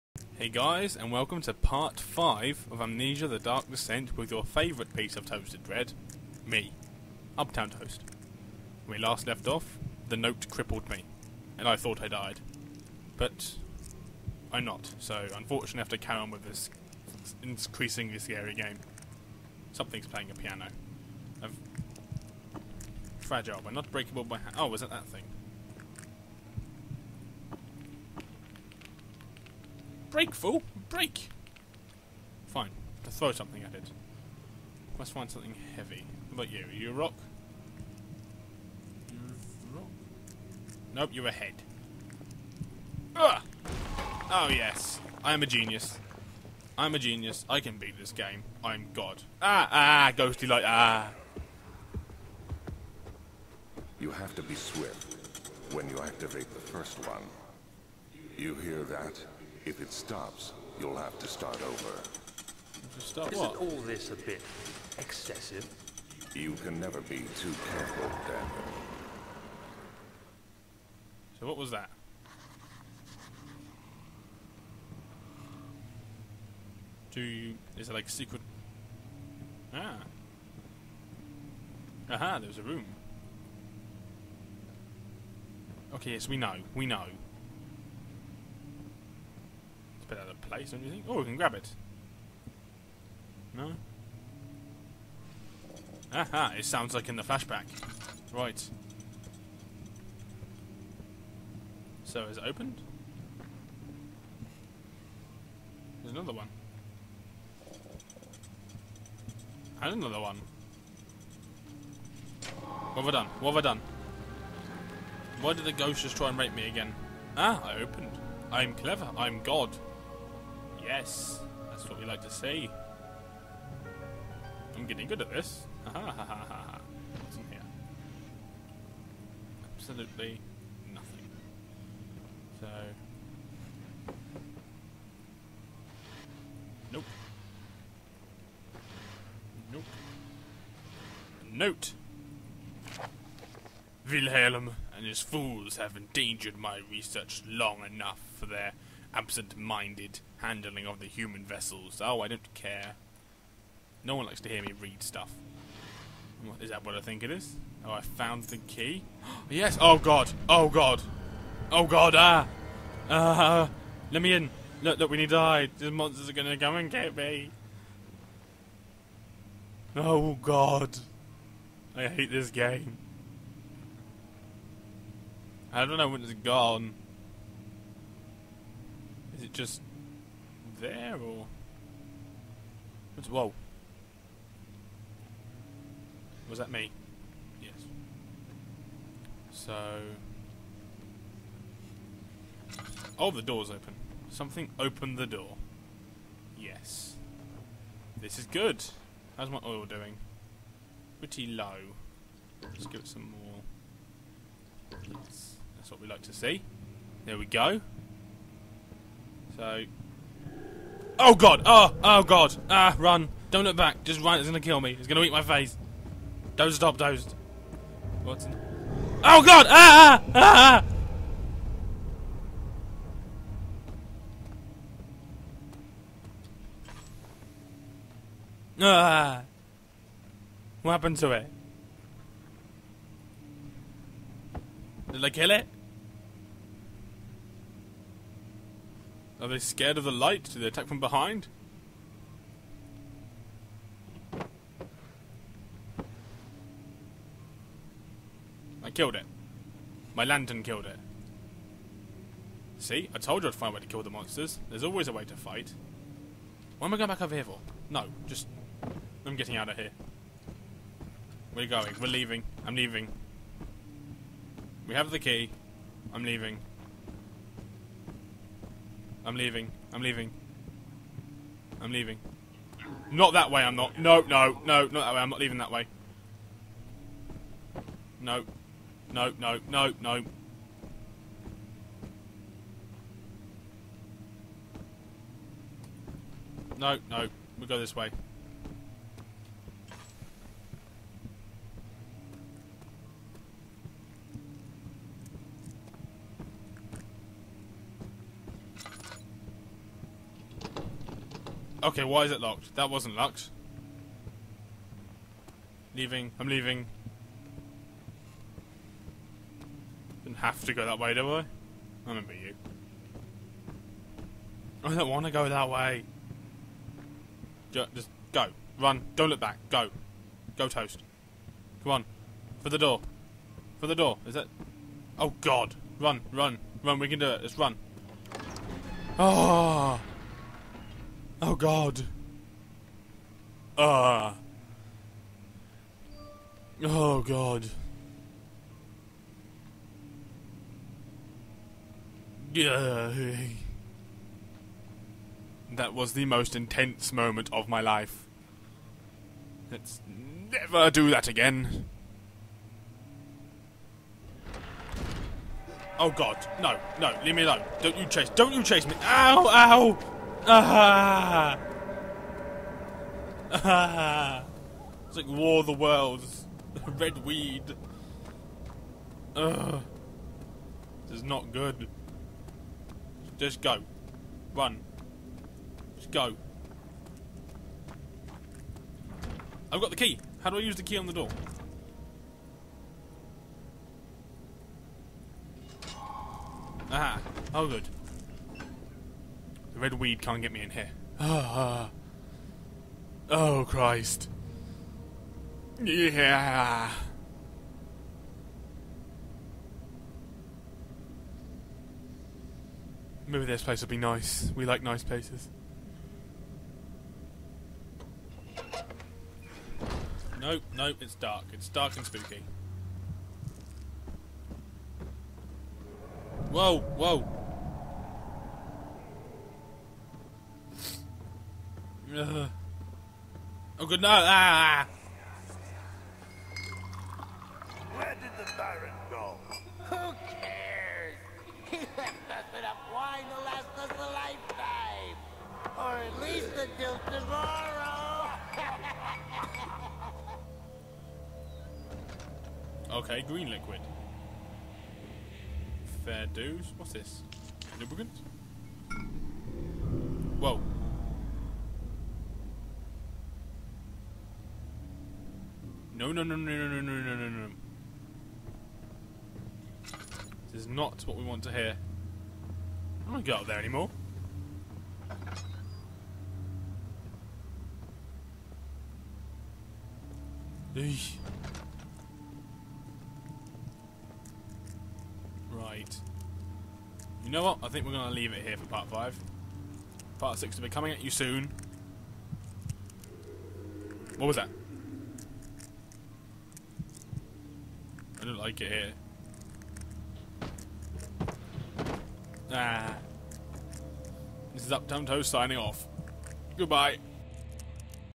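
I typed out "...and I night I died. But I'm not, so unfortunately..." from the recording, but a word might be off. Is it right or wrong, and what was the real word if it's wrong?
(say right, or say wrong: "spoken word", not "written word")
wrong: "thought", not "night".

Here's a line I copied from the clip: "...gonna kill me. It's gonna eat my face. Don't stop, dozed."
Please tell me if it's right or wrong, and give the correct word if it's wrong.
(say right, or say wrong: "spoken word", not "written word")
right.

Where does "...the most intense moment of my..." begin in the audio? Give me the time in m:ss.
5:46.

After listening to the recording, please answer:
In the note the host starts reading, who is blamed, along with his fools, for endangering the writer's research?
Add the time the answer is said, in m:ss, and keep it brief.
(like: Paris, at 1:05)
Wilhelm, at 2:24.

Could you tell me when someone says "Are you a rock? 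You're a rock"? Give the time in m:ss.
0:36.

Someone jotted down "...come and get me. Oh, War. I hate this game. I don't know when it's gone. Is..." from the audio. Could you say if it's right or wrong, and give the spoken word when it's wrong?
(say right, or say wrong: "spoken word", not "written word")
wrong: "God", not "War".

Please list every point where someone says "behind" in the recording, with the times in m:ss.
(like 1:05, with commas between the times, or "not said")
4:00.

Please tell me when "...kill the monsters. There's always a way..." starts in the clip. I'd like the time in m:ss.
4:13.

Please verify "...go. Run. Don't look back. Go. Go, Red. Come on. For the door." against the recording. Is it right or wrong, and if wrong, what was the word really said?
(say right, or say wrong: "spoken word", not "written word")
wrong: "Toast", not "Red".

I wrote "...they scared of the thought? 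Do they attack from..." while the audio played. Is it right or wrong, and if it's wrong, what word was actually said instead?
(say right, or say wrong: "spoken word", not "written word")
wrong: "light", not "thought".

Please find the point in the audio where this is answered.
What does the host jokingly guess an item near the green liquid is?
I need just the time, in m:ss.
7:27.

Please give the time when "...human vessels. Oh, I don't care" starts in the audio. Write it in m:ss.
2:31.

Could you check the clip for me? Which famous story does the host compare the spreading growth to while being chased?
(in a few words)
War of the Worlds.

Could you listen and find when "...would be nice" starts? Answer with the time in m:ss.
6:43.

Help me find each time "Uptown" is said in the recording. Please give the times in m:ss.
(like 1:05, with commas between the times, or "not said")
0:07, 8:14.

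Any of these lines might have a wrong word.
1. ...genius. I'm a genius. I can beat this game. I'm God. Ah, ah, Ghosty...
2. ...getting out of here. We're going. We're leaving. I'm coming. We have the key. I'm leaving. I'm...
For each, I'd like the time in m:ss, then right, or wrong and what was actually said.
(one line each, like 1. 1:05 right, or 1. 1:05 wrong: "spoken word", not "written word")
1. 0:45 right
2. 4:19 wrong: "leaving", not "coming".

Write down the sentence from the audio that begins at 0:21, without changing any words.
I've fragile, but not breakable by hand.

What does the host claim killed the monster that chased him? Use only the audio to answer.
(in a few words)
My lantern.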